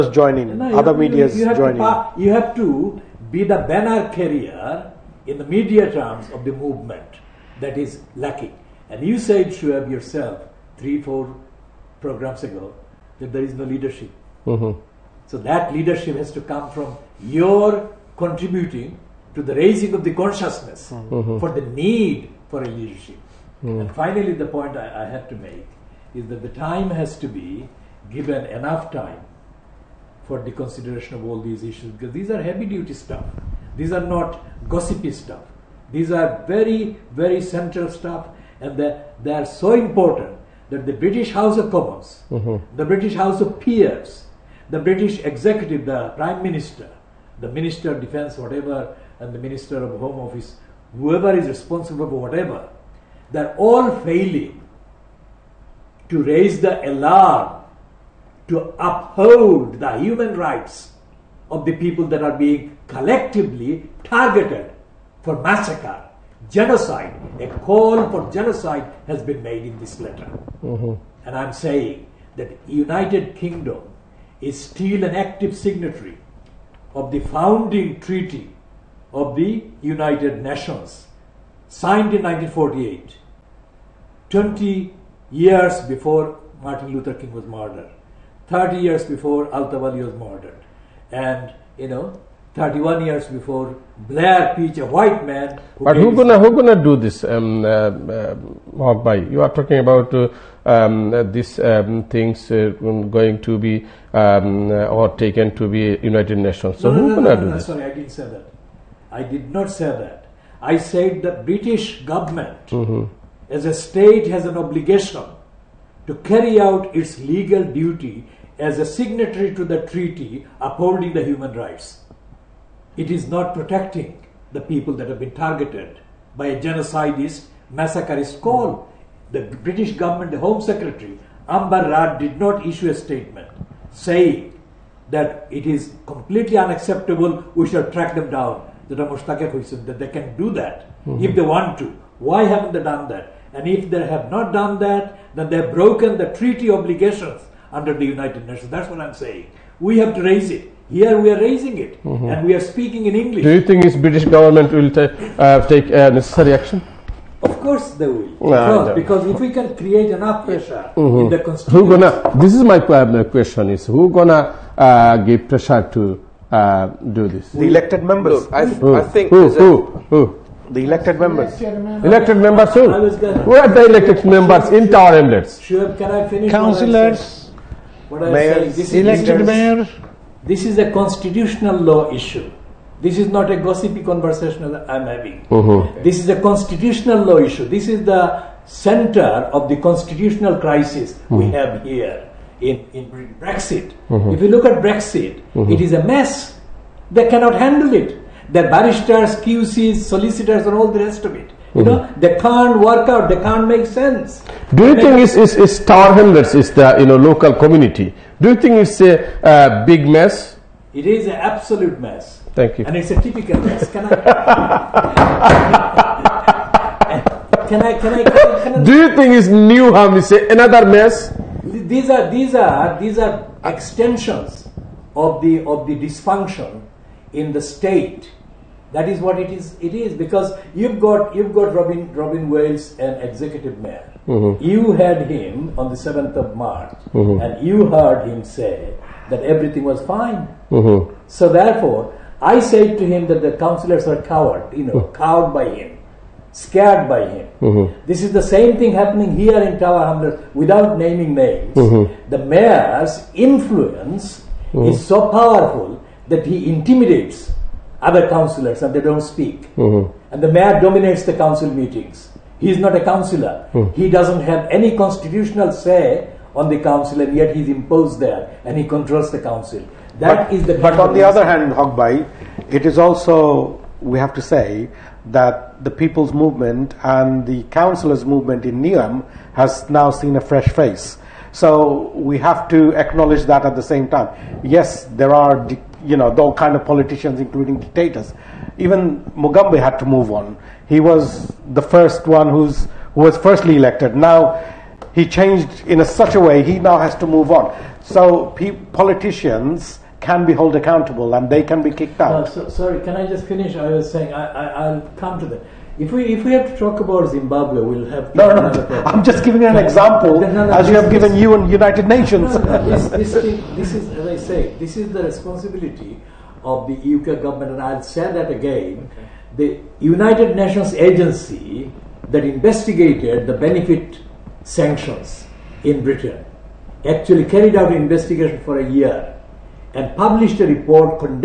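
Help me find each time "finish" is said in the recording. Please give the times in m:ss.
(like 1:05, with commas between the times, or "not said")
2:56, 5:03.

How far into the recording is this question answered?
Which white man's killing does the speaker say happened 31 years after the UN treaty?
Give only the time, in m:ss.
1:33.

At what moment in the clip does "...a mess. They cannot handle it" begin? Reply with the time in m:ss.
3:15.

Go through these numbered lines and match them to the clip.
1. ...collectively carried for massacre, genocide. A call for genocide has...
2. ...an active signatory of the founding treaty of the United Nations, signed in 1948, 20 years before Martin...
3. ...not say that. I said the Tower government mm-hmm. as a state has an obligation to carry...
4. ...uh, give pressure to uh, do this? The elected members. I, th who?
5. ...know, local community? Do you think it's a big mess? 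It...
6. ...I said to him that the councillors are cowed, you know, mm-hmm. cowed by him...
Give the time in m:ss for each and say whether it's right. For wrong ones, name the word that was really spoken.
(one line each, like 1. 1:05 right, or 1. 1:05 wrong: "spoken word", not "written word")
1. 1:02 wrong: "targeted", not "carried"
2. 1:15 right
3. 1:49 wrong: "British", not "Tower"
4. 2:44 right
5. 3:27 right
6. 4:02 right.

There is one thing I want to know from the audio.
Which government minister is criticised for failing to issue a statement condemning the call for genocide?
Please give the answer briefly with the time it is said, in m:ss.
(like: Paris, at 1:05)
Amber Rudd, at 2:11.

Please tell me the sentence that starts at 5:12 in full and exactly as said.
this, this, this is as I say, this is the responsibility of the UK government, and I'll say that again.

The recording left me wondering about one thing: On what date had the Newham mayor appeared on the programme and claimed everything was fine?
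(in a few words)
7 March.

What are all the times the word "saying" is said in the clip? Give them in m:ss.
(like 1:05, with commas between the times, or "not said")
1:11, 2:13, 2:29, 5:04.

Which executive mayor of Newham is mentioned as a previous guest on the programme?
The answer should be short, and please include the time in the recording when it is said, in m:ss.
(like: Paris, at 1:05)
Robin Wales, at 3:52.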